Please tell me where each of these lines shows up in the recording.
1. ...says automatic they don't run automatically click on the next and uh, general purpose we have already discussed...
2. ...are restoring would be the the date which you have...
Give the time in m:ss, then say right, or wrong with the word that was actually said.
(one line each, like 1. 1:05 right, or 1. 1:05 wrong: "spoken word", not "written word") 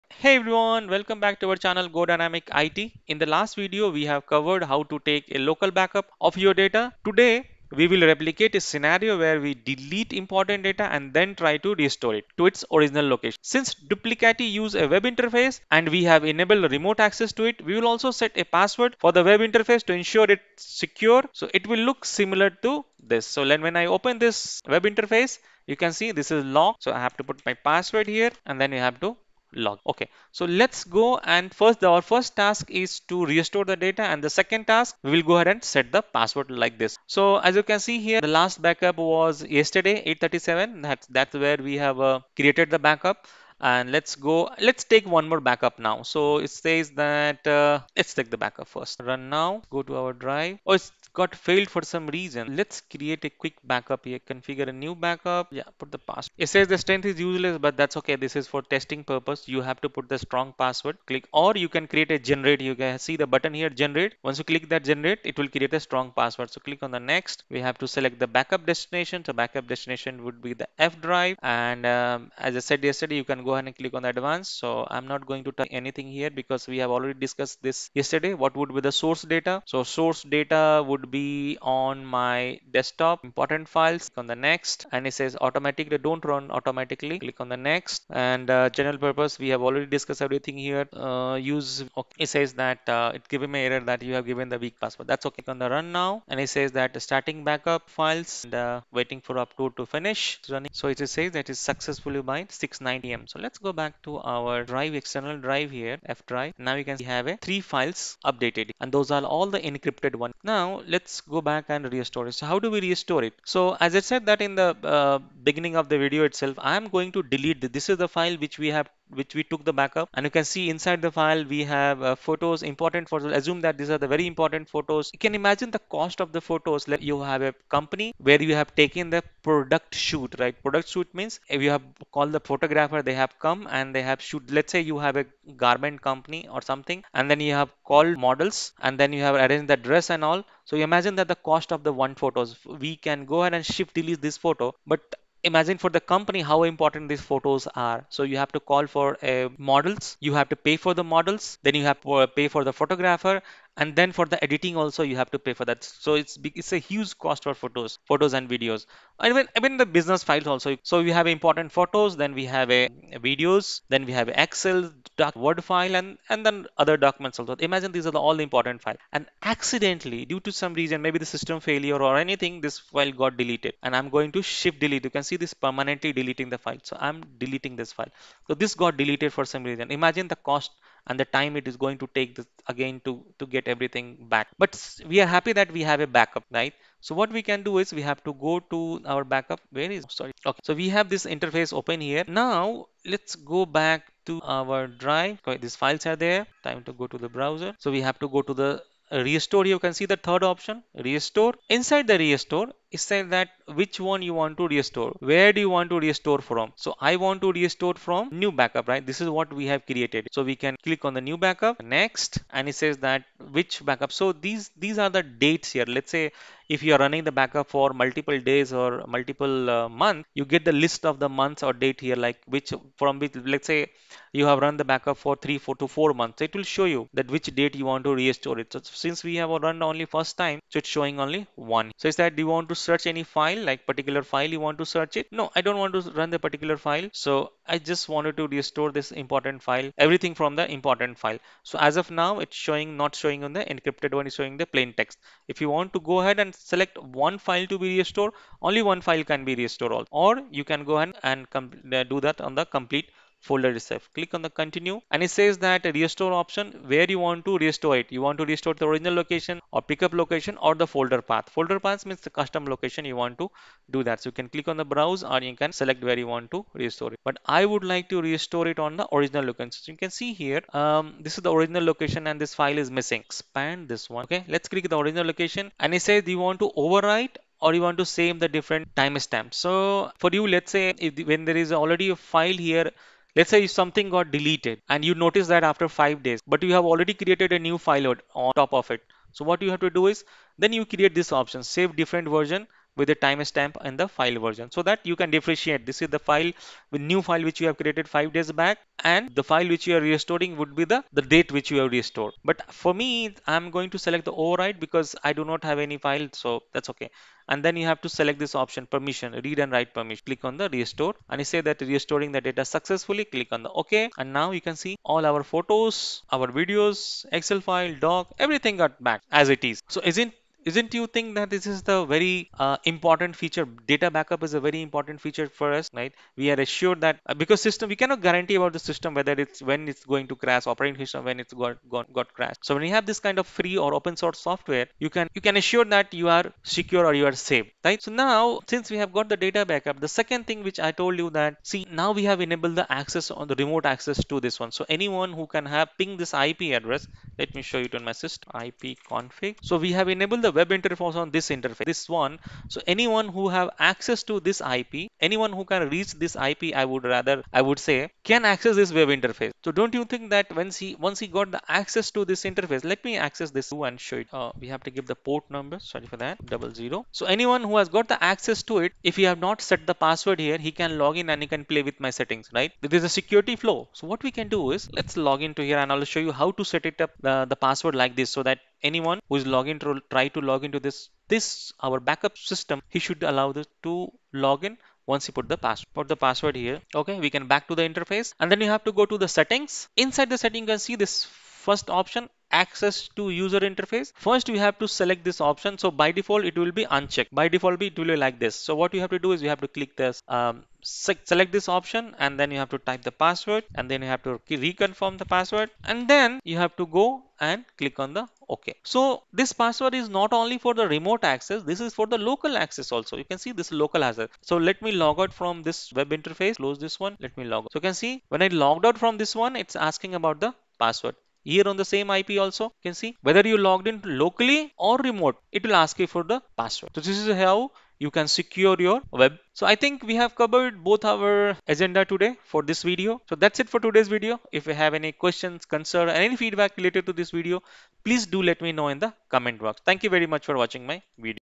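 1. 1:25 right
2. 4:59 right.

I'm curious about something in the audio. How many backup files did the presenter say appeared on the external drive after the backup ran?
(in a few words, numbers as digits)
3.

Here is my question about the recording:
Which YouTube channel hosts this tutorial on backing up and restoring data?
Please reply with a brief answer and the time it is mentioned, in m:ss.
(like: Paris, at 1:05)
Go Dynamic IT, at 0:01.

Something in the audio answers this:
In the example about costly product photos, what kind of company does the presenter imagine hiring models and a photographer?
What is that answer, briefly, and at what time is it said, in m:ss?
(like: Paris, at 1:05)
garment company, at 2:15.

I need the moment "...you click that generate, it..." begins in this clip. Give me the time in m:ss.
1:04.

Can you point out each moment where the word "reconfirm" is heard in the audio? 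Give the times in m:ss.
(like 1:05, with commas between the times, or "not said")
6:44.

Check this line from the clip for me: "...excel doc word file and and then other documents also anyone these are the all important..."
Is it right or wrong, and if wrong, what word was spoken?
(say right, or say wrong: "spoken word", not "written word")
wrong: "imagine", not "anyone".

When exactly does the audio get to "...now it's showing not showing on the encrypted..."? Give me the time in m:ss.
4:02.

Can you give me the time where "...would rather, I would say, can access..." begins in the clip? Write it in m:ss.
5:56.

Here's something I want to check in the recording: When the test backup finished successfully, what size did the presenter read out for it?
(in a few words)
690 MB.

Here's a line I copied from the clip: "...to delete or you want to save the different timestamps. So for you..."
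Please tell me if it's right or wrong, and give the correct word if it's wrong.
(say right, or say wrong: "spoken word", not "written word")
wrong: "overwrite", not "delete".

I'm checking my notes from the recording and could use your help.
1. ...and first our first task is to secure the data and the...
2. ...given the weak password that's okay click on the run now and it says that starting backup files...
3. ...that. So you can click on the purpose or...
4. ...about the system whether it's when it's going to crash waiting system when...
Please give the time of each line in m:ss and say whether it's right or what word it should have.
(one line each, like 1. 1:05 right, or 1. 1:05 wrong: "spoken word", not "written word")
1. 0:31 wrong: "restore", not "secure"
2. 1:34 right
3. 4:24 wrong: "browse", not "purpose"
4. 5:28 wrong: "operating", not "waiting".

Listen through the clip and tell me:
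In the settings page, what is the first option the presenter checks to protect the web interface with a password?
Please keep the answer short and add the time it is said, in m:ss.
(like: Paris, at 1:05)
access to user interface, at 6:32.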